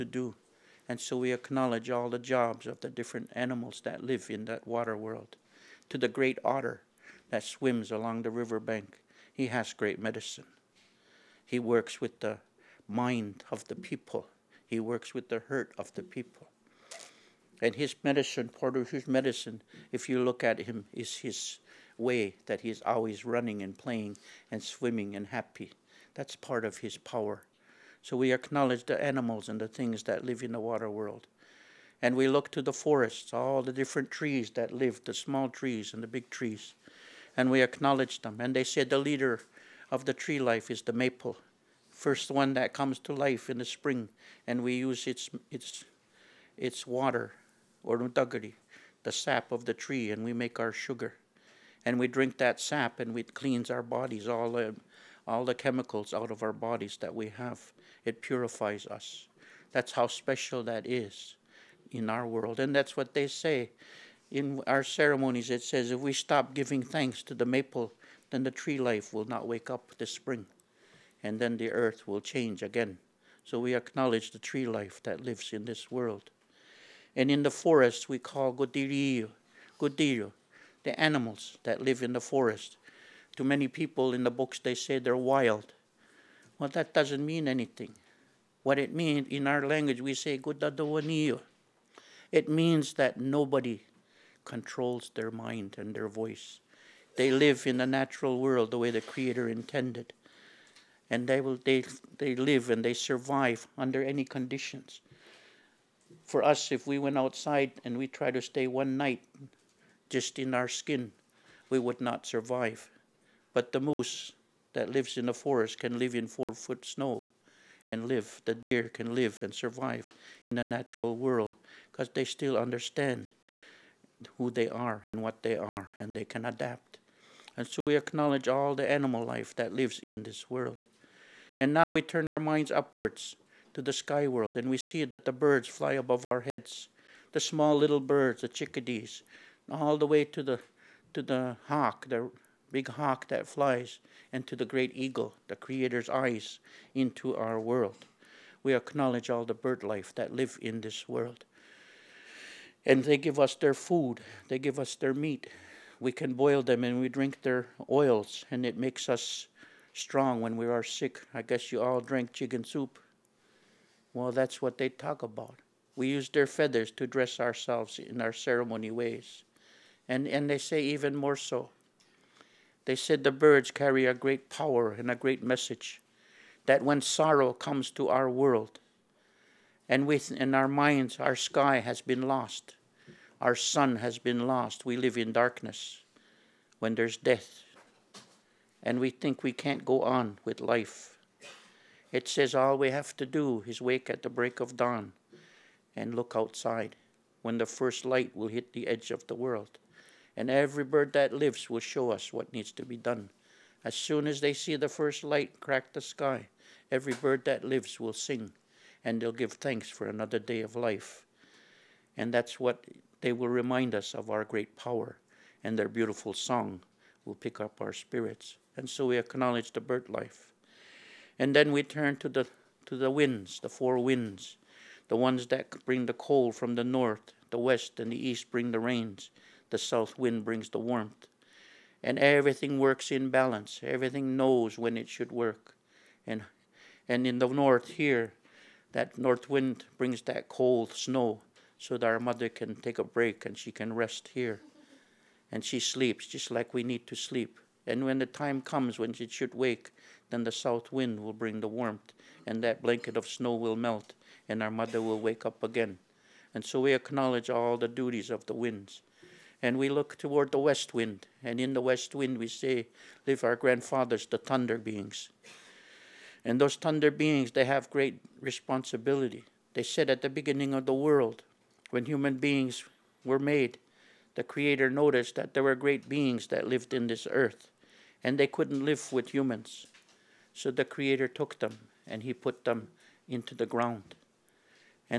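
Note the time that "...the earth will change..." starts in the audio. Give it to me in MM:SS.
01:11.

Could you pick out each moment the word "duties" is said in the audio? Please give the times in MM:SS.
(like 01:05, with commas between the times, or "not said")
04:17.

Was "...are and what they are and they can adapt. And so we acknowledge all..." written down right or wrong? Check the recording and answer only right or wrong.
right.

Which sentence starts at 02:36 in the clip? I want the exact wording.
We can boil them and we drink their oils, and it makes us strong when we are sick.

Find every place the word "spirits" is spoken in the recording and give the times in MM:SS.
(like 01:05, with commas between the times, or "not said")
03:37.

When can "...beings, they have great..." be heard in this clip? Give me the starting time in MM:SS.
04:27.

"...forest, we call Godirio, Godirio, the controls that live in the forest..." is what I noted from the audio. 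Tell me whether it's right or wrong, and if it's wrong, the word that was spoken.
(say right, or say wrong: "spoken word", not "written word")
wrong: "animals", not "controls".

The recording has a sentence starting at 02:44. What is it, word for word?
Well, that's what they talk about.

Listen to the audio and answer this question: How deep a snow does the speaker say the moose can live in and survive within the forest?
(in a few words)
4 foot.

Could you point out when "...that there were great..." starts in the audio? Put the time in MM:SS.
04:35.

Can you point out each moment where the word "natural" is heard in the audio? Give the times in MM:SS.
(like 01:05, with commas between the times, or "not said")
01:37, 02:00.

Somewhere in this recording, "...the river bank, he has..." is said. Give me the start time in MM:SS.
00:08.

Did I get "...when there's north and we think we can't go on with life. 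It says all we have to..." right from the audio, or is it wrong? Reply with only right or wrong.
wrong.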